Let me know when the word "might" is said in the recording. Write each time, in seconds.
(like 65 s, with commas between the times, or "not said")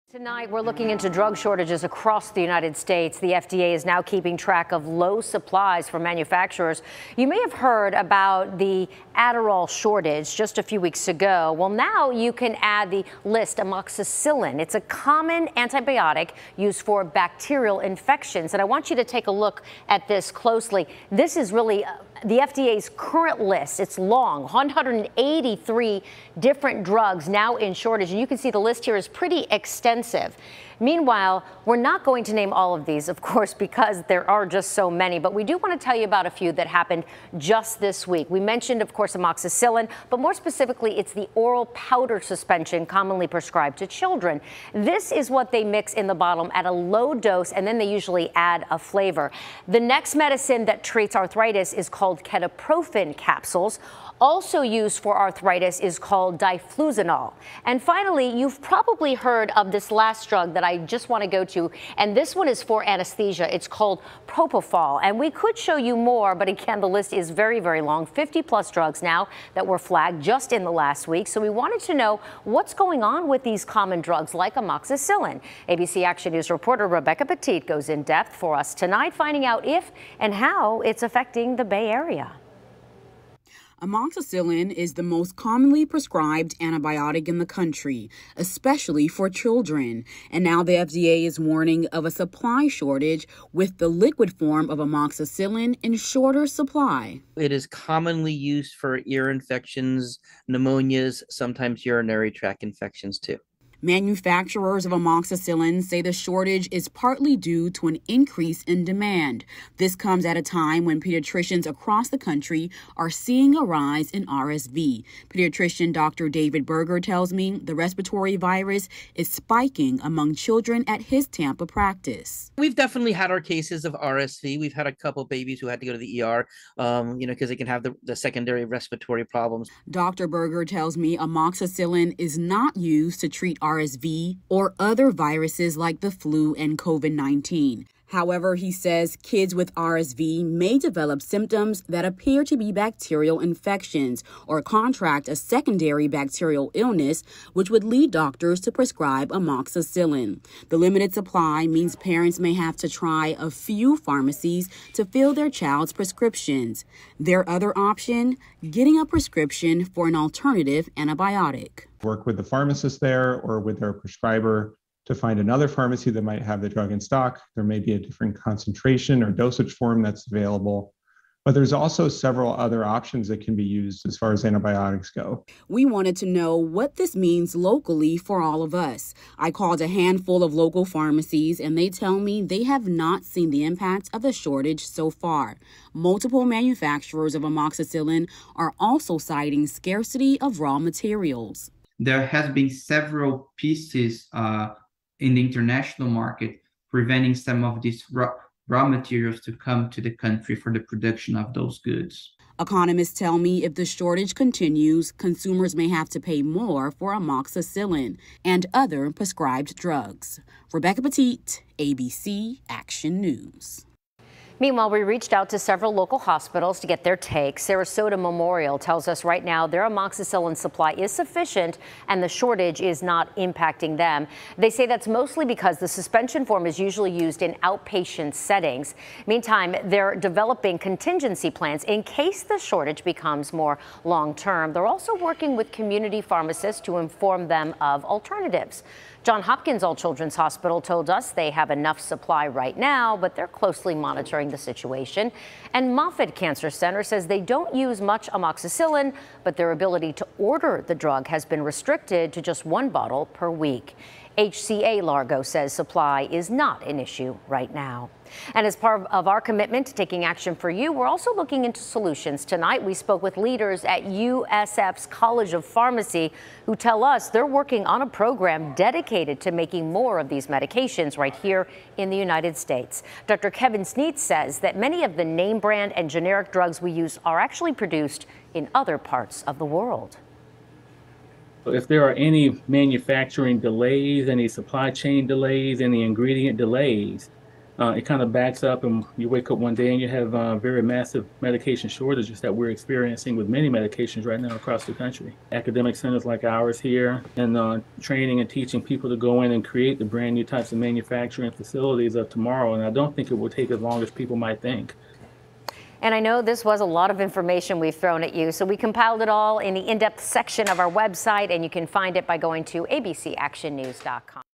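166 s, 304 s.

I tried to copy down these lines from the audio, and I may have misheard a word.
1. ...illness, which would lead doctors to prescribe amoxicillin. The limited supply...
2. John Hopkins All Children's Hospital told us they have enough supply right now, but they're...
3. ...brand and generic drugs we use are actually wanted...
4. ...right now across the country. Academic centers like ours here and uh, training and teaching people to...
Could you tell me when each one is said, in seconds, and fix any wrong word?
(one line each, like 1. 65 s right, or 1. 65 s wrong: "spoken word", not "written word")
1. 146 s right
2. 239 s right
3. 275 s wrong: "produced", not "wanted"
4. 294 s right.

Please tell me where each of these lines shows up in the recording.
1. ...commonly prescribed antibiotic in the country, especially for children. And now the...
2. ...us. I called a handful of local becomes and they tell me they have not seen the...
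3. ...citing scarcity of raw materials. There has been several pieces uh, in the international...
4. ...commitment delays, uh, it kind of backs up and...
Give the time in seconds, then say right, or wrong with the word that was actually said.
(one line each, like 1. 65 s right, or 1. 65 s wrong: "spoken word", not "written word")
1. 85 s right
2. 178 s wrong: "pharmacies", not "becomes"
3. 189 s right
4. 286 s wrong: "ingredient", not "commitment".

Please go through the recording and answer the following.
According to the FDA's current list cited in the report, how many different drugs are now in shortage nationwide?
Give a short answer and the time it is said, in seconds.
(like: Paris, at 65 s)
183, at 24 s.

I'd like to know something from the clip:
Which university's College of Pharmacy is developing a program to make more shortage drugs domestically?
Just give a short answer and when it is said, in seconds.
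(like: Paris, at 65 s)
USF, at 264 s.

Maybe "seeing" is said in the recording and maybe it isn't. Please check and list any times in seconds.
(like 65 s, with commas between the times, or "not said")
113 s.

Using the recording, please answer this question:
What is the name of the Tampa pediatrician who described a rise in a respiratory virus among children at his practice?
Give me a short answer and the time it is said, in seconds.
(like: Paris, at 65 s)
Dr. David Berger, at 115 s.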